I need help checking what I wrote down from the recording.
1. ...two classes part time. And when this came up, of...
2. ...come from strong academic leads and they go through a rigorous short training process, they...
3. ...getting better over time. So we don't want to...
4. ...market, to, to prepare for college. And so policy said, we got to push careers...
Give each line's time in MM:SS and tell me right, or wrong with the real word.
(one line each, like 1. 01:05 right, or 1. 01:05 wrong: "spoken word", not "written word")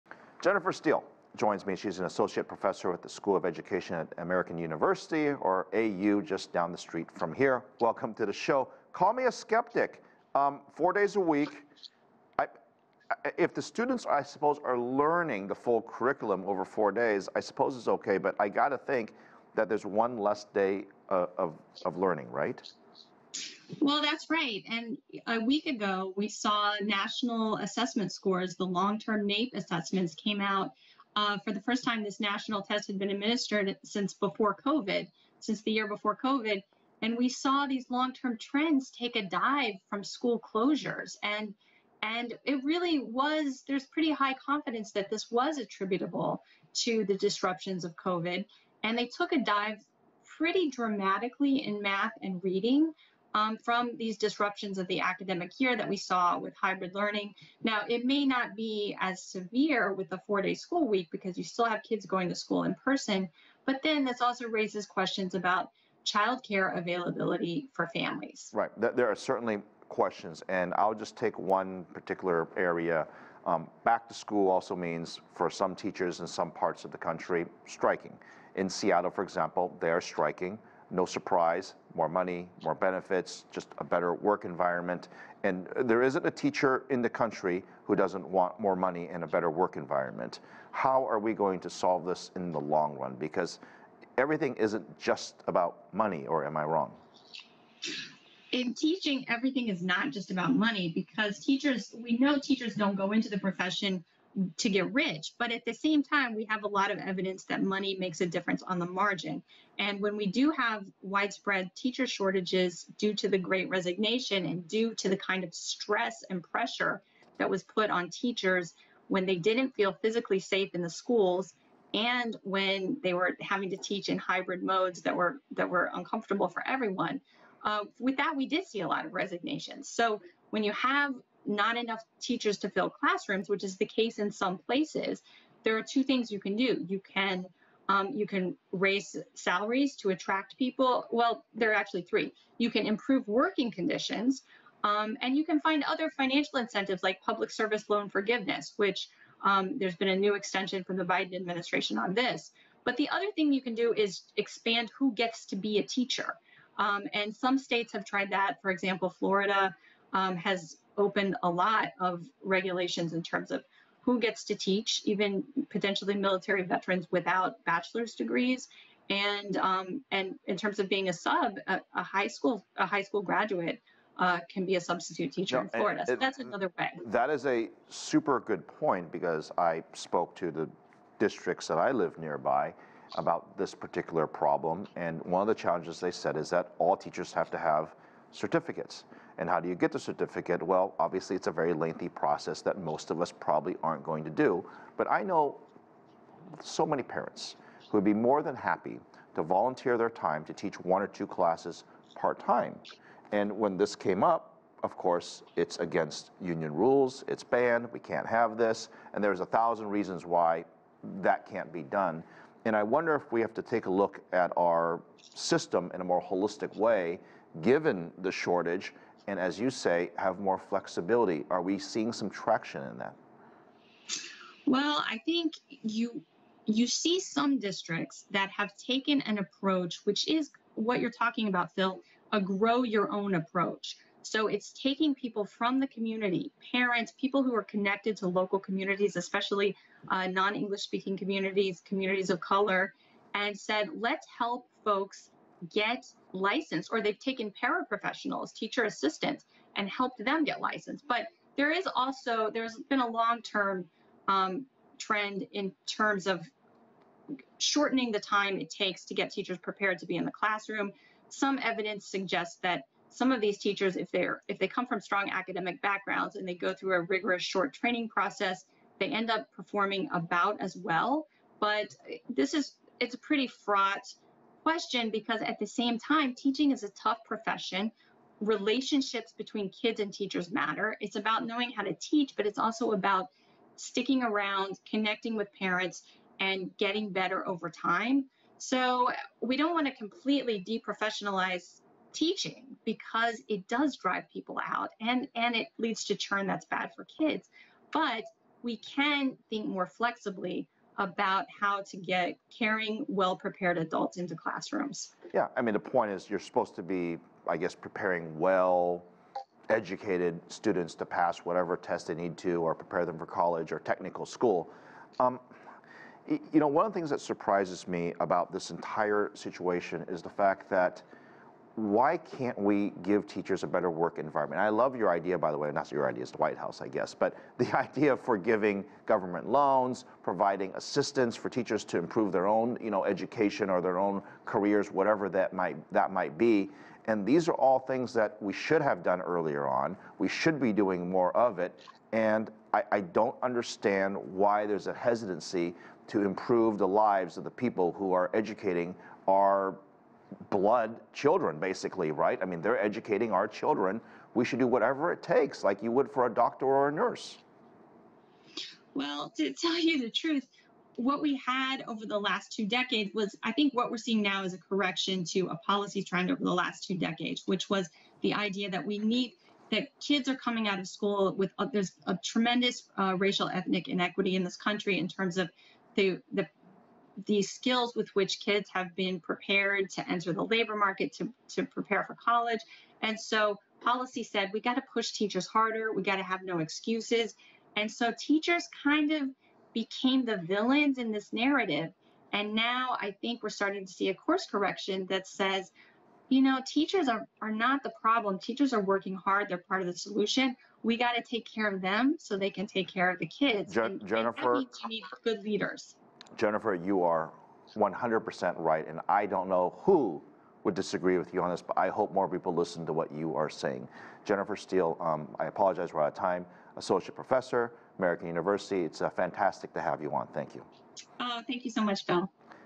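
1. 03:21 right
2. 04:24 wrong: "backgrounds", not "leads"
3. 04:46 right
4. 06:20 wrong: "teachers", not "careers".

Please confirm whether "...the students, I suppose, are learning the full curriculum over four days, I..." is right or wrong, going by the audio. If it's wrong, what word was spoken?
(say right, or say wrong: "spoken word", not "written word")
right.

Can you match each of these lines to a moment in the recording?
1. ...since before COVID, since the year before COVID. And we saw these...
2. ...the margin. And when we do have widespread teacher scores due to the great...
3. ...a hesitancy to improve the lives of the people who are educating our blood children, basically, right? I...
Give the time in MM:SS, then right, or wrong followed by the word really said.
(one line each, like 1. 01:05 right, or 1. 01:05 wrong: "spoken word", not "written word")
1. 00:33 right
2. 01:48 wrong: "shortages", not "scores"
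3. 05:44 right.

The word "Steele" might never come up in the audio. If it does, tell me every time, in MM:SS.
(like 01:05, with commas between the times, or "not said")
00:00, 06:54.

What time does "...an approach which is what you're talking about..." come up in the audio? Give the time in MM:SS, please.
03:49.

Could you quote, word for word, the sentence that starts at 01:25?
And there isn't a teacher in the country who doesn't want more money and a better work environment.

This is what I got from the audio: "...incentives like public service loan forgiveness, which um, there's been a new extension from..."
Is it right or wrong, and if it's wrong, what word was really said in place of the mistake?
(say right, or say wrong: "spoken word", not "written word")
right.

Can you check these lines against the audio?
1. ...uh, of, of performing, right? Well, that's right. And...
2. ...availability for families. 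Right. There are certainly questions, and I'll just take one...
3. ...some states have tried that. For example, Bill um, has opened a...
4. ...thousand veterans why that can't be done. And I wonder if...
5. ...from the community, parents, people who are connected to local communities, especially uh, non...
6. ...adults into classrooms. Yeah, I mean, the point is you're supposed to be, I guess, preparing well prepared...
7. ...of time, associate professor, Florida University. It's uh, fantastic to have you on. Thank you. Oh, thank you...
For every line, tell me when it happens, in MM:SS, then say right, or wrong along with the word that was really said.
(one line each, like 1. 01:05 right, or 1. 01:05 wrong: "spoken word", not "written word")
1. 00:21 wrong: "learning", not "performing"
2. 01:06 right
3. 02:37 wrong: "Florida", not "Bill"
4. 03:29 wrong: "reasons", not "veterans"
5. 03:55 right
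6. 05:03 wrong: "educated", not "prepared"
7. 06:56 wrong: "American", not "Florida".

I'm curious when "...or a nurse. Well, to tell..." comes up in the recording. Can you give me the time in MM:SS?
05:56.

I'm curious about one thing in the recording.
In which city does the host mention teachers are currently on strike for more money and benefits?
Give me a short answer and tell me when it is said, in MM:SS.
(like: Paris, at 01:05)
Seattle, at 01:18.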